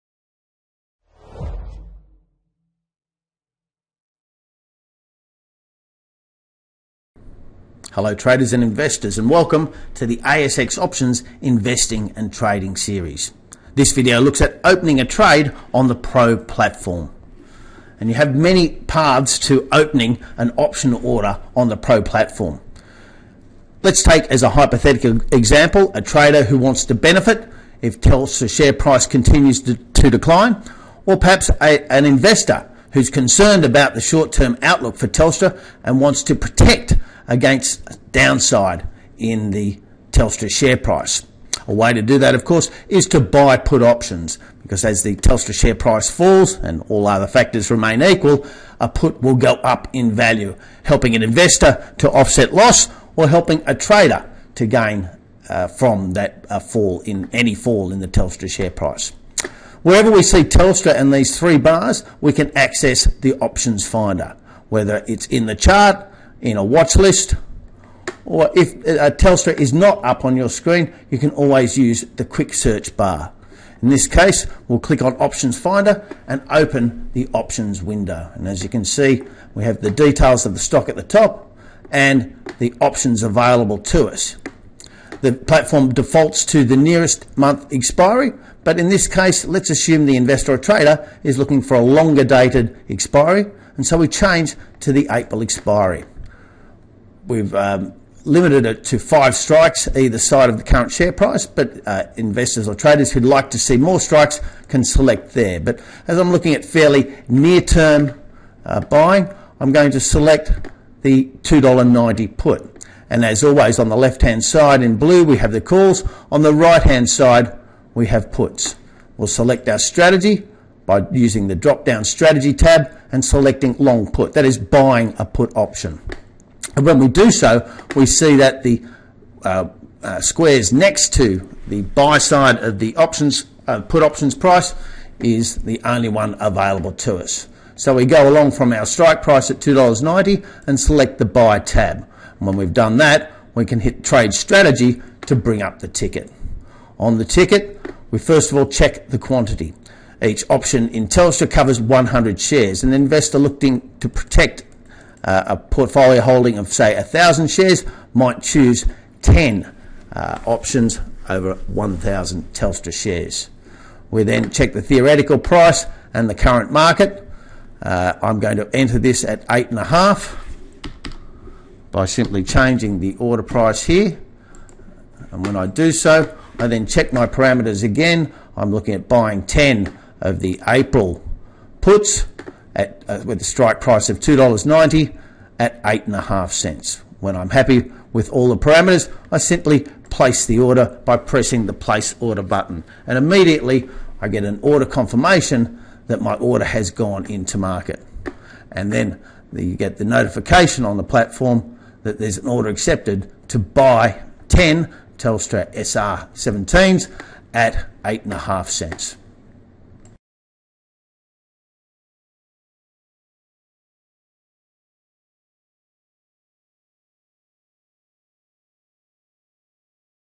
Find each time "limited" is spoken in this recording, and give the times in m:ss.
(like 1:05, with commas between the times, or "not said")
1:38.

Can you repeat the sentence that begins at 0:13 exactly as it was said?
This video looks at opening a trade on the Pro platform.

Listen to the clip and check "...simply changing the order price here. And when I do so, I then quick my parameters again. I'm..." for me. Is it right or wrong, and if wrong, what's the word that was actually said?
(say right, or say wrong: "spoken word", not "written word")
wrong: "check", not "quick".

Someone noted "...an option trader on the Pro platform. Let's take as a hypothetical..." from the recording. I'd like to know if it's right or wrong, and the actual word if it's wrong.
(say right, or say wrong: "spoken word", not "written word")
wrong: "order", not "trader".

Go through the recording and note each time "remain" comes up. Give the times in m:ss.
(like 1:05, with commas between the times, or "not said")
0:47.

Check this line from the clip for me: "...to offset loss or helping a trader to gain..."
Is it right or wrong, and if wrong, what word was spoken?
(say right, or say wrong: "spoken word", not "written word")
right.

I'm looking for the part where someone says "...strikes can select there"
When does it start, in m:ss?
1:43.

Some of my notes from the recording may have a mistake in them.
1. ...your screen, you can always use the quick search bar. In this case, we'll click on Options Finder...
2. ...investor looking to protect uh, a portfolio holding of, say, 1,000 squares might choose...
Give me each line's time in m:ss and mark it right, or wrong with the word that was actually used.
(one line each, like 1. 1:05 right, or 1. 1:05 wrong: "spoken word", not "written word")
1. 1:10 right
2. 2:32 wrong: "shares", not "squares".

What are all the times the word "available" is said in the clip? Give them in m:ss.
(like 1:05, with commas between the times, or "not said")
1:23, 2:16.